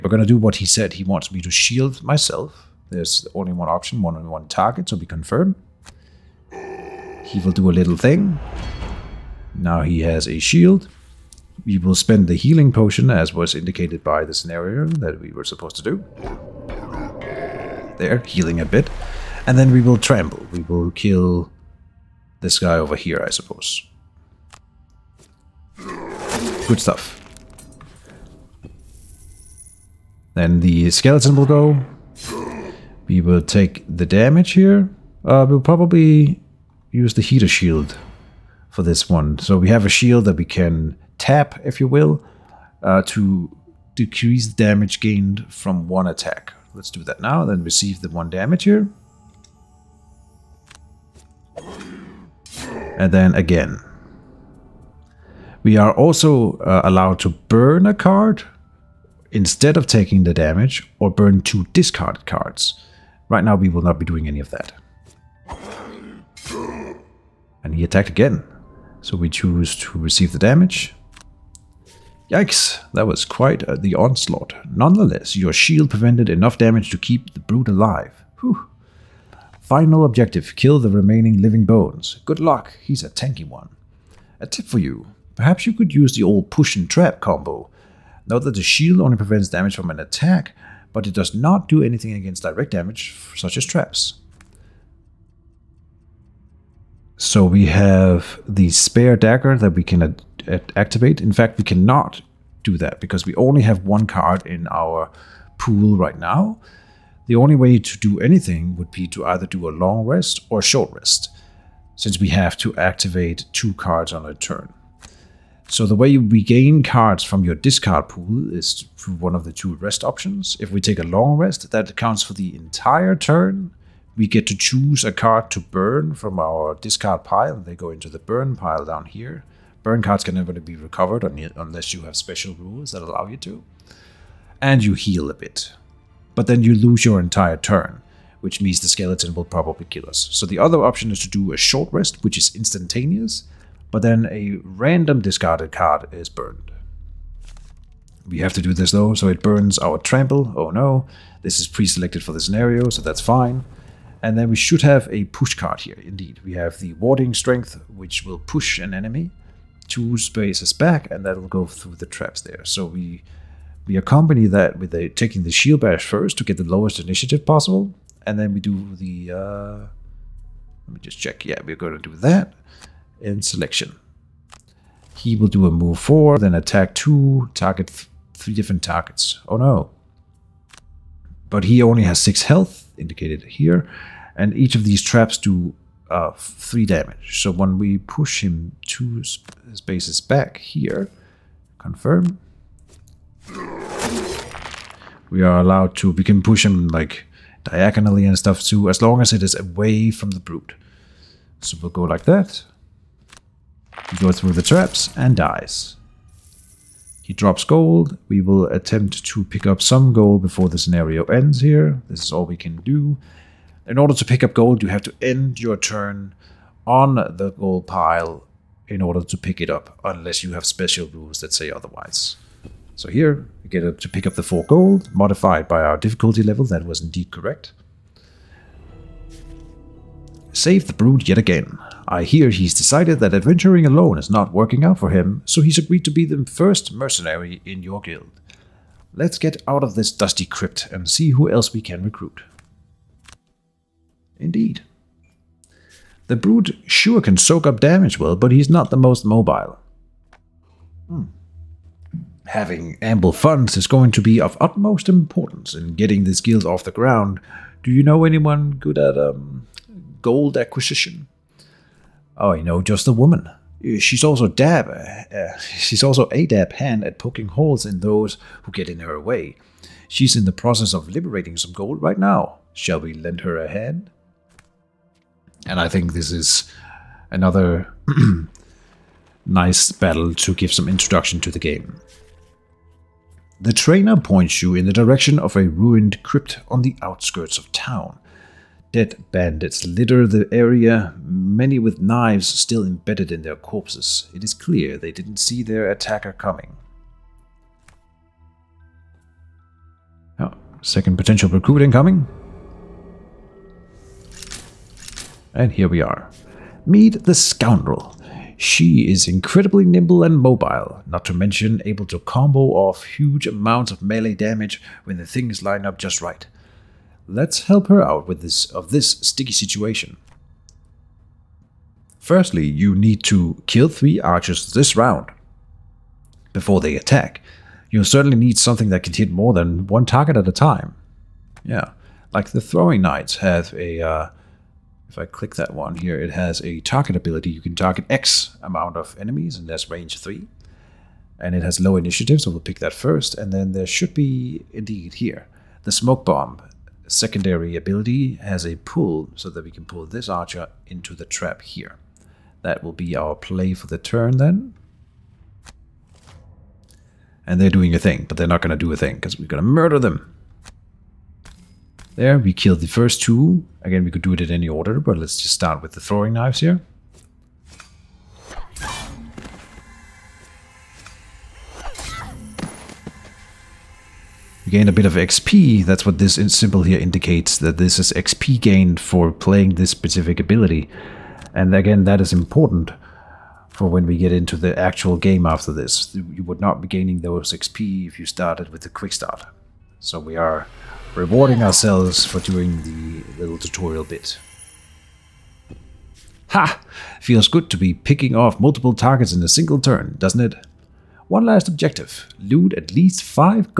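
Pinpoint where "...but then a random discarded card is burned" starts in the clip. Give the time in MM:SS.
02:23.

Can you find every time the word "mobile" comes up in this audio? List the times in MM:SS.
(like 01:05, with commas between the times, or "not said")
04:09, 05:10.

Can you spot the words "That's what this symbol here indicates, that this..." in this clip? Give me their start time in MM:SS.
06:15.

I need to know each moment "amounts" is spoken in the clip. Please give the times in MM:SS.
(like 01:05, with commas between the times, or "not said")
05:13, 05:38.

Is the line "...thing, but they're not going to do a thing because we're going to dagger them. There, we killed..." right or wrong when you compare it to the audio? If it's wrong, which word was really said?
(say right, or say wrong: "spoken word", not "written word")
wrong: "murder", not "dagger".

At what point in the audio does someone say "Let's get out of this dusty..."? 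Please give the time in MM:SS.
03:59.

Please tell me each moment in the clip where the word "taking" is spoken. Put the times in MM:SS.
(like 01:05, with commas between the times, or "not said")
00:59, 02:45.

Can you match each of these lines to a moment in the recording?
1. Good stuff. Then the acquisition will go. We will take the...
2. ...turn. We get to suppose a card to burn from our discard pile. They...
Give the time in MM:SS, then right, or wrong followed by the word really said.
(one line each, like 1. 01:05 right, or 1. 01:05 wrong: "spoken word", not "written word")
1. 00:25 wrong: "skeleton", not "acquisition"
2. 02:03 wrong: "choose", not "suppose".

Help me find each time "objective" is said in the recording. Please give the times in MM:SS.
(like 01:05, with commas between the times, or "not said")
01:20, 06:41.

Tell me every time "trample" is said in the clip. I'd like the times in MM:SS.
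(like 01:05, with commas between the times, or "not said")
00:19, 02:29.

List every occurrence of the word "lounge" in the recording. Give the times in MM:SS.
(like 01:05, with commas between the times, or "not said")
not said.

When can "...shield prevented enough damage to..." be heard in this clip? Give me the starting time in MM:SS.
01:15.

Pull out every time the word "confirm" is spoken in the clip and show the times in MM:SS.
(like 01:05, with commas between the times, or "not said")
00:05, 03:11.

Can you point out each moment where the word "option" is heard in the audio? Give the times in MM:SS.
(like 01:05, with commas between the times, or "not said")
00:03, 02:00, 02:20.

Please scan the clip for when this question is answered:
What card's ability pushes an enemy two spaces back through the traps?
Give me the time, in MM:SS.
02:36.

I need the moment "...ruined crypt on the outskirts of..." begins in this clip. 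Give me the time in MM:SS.
04:45.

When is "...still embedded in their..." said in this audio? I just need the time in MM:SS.
04:52.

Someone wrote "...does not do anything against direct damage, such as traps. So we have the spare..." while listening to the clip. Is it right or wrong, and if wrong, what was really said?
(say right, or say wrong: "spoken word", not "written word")
right.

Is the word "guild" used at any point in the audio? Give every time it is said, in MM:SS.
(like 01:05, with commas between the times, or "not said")
03:57, 04:16.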